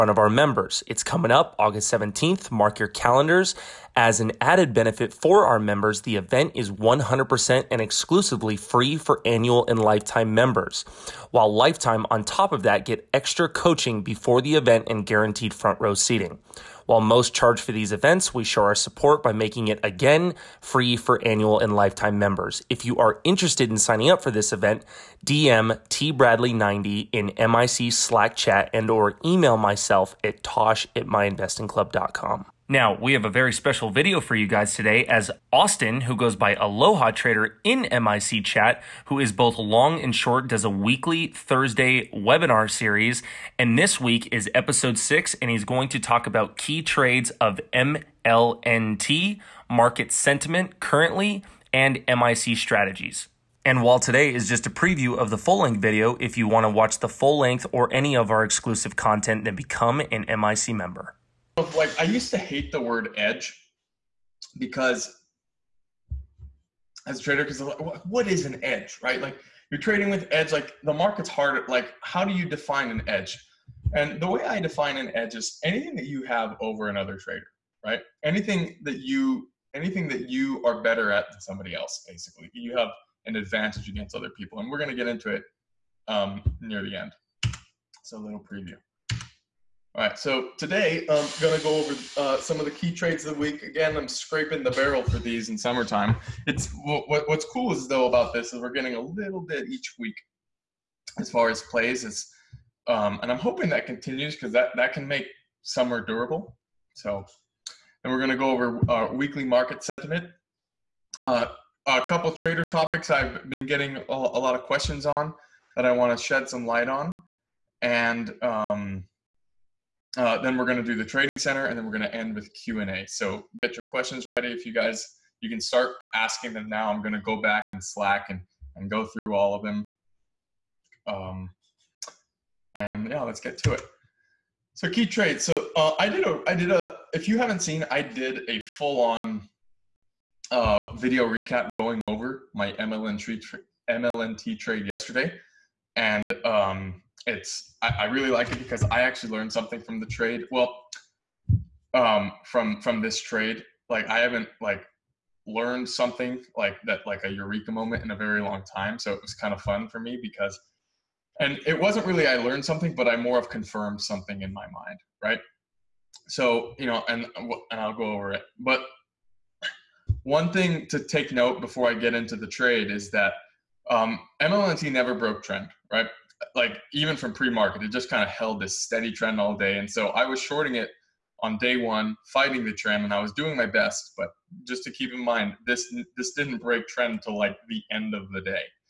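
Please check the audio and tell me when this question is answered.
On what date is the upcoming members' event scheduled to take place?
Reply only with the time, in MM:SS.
00:01.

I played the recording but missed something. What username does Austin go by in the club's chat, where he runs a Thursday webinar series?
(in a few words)
Aloha Trader.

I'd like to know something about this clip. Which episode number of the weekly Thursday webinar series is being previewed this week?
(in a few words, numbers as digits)
6.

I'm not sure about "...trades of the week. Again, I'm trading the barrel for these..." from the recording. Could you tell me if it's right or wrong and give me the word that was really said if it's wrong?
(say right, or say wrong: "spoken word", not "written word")
wrong: "scraping", not "trading".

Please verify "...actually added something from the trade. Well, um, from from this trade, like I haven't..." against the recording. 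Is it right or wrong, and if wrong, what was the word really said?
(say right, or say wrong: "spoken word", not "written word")
wrong: "learned", not "added".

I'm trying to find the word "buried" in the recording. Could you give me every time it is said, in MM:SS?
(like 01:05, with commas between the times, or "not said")
not said.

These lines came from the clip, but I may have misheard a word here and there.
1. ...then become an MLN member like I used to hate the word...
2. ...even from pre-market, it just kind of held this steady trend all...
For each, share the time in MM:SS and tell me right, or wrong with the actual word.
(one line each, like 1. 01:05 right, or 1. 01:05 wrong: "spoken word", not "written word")
1. 00:59 wrong: "MIC", not "MLN"
2. 02:56 right.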